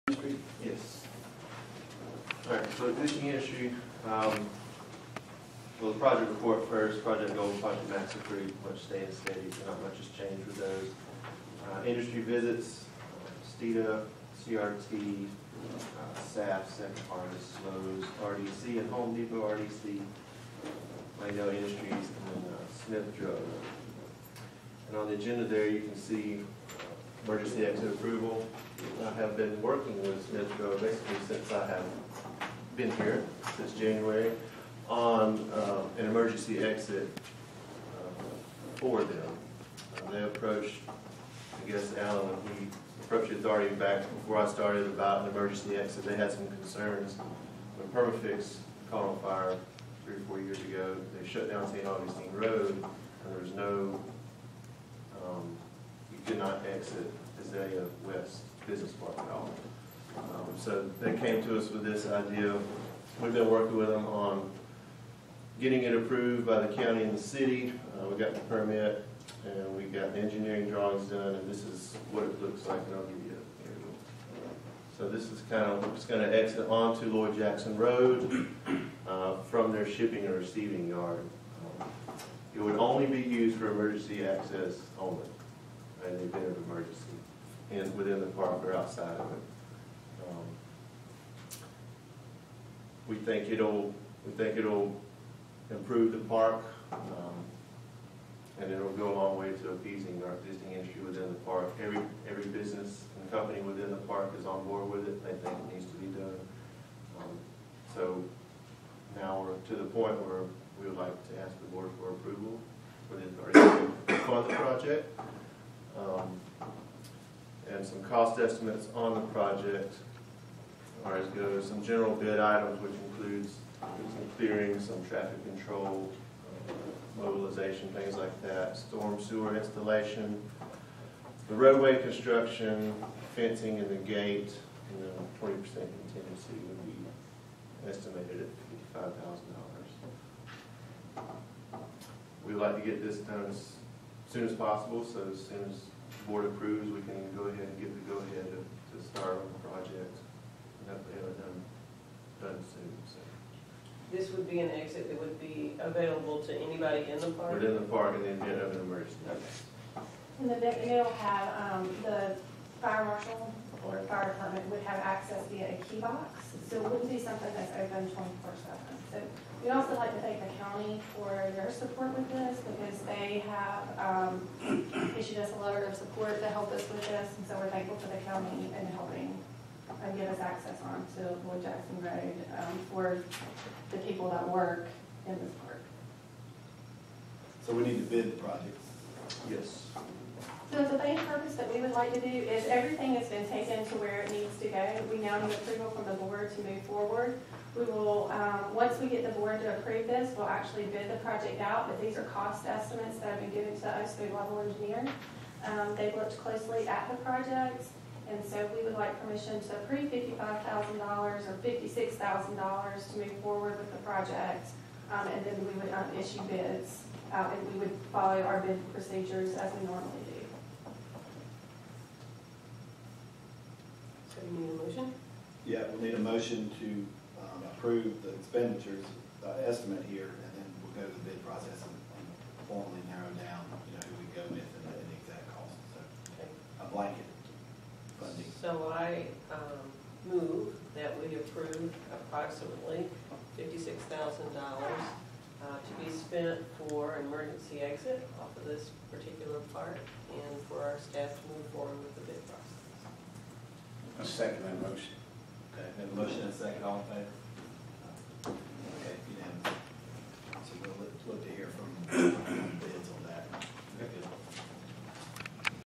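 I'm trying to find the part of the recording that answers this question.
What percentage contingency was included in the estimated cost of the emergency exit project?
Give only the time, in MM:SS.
02:15.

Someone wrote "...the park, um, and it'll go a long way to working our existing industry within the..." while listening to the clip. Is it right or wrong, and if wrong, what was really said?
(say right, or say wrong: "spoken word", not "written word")
wrong: "appeasing", not "working".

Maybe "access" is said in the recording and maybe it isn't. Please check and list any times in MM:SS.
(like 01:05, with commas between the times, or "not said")
01:24, 02:44, 03:00.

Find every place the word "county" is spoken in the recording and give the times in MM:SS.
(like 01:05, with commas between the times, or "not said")
01:06, 02:50, 02:58.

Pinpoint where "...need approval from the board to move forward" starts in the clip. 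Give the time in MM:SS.
03:15.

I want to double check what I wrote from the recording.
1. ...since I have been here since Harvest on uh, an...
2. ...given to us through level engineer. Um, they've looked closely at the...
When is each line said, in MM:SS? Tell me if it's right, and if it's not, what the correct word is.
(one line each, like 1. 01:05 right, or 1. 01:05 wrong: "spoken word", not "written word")
1. 00:31 wrong: "January", not "Harvest"
2. 03:23 right.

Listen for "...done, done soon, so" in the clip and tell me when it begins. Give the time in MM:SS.
02:30.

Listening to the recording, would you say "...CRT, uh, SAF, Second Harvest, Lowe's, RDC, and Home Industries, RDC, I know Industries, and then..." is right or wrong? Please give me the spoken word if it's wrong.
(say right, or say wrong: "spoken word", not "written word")
wrong: "Depot", not "Industries".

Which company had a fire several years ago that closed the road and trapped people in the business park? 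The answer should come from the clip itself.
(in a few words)
Perma-Fix.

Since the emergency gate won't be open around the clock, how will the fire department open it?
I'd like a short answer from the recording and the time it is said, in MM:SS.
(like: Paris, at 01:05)
a key box, at 02:45.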